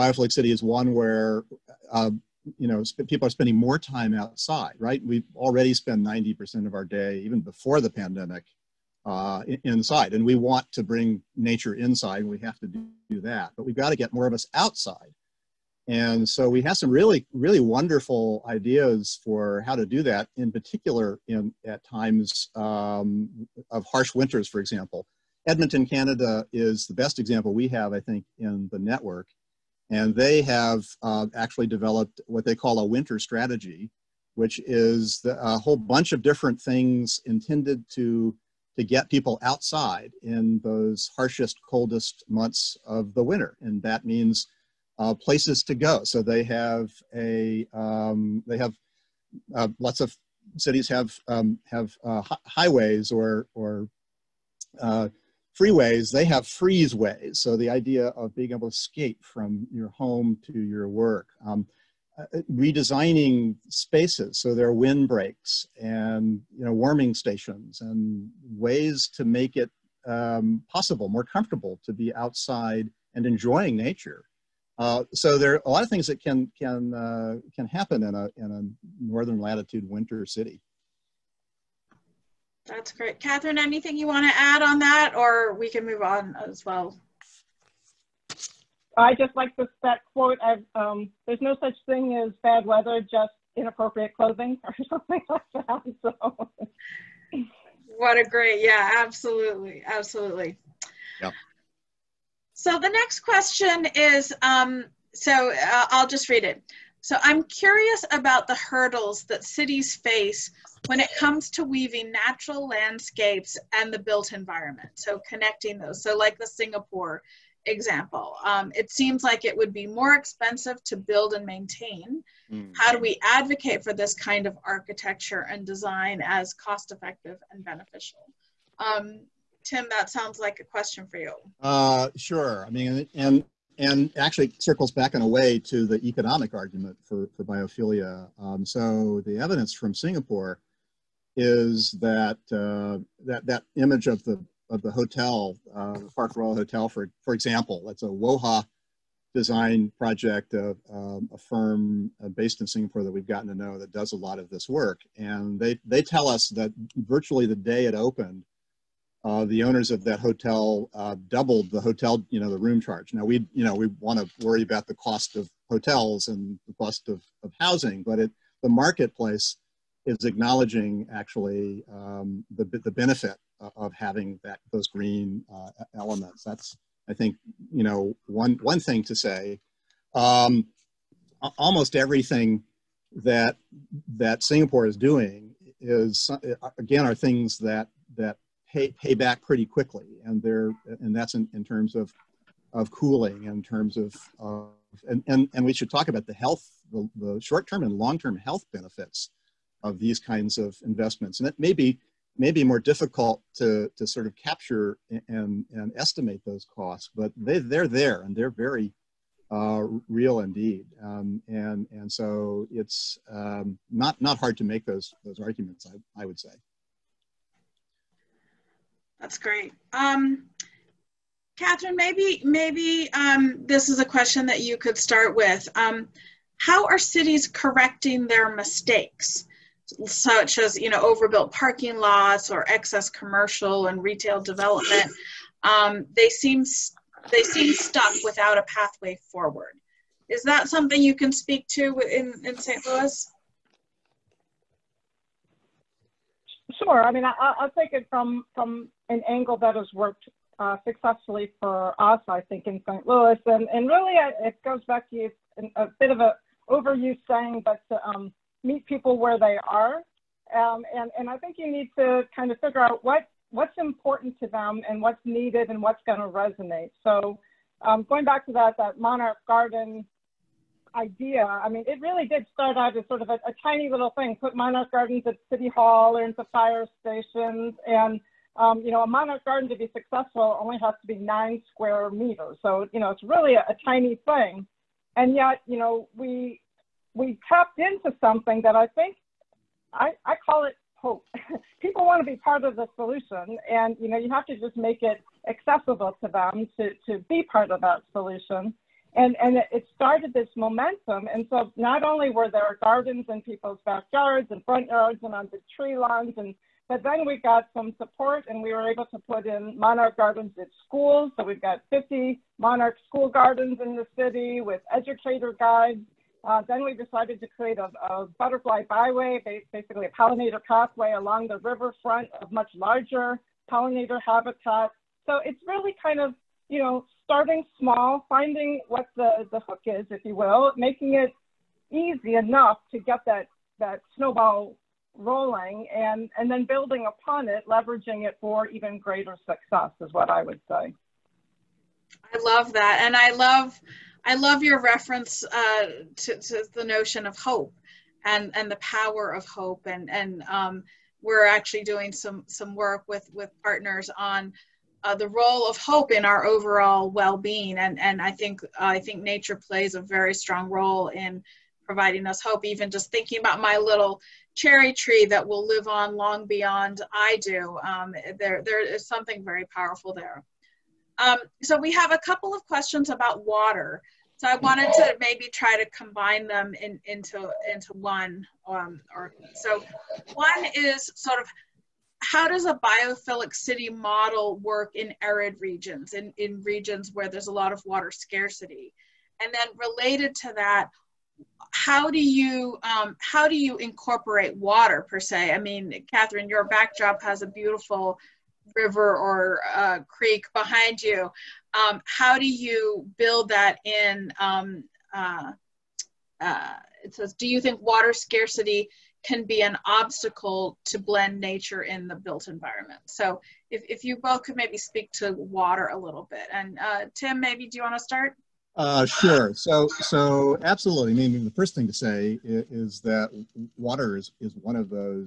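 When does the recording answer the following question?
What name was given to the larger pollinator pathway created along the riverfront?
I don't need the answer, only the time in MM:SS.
05:18.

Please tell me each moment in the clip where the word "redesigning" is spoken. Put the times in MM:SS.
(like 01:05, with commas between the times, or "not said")
01:02.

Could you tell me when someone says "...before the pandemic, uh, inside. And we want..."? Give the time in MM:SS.
00:07.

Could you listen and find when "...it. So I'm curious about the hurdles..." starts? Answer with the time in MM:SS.
01:46.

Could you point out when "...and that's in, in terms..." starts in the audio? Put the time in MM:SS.
03:10.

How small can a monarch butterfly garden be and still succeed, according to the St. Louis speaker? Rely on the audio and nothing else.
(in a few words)
9 square meters.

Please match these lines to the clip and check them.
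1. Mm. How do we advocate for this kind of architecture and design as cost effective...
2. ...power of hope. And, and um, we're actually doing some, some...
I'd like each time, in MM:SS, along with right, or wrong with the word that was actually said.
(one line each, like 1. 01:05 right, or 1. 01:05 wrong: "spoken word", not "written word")
1. 02:02 right
2. 05:48 right.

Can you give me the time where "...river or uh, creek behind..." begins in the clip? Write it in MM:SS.
06:38.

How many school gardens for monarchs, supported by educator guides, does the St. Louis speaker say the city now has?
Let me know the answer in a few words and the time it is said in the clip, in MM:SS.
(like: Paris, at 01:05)
50, at 05:11.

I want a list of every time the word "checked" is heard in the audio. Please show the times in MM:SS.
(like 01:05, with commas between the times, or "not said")
not said.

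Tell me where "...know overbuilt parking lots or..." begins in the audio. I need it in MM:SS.
03:50.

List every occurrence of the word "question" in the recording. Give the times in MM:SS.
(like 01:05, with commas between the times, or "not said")
01:43, 02:10, 03:44, 06:12.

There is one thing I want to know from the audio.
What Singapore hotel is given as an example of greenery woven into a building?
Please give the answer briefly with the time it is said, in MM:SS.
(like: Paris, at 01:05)
Park Royal Hotel, at 02:26.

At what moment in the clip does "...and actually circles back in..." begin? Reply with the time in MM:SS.
02:13.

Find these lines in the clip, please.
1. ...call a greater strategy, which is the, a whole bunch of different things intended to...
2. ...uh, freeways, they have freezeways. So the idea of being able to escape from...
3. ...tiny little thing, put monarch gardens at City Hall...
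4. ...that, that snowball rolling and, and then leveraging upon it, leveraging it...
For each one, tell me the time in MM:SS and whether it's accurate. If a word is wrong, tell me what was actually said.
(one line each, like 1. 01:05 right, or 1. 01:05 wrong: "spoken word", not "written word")
1. 00:32 wrong: "winter", not "greater"
2. 00:54 right
3. 04:33 right
4. 05:33 wrong: "building", not "leveraging".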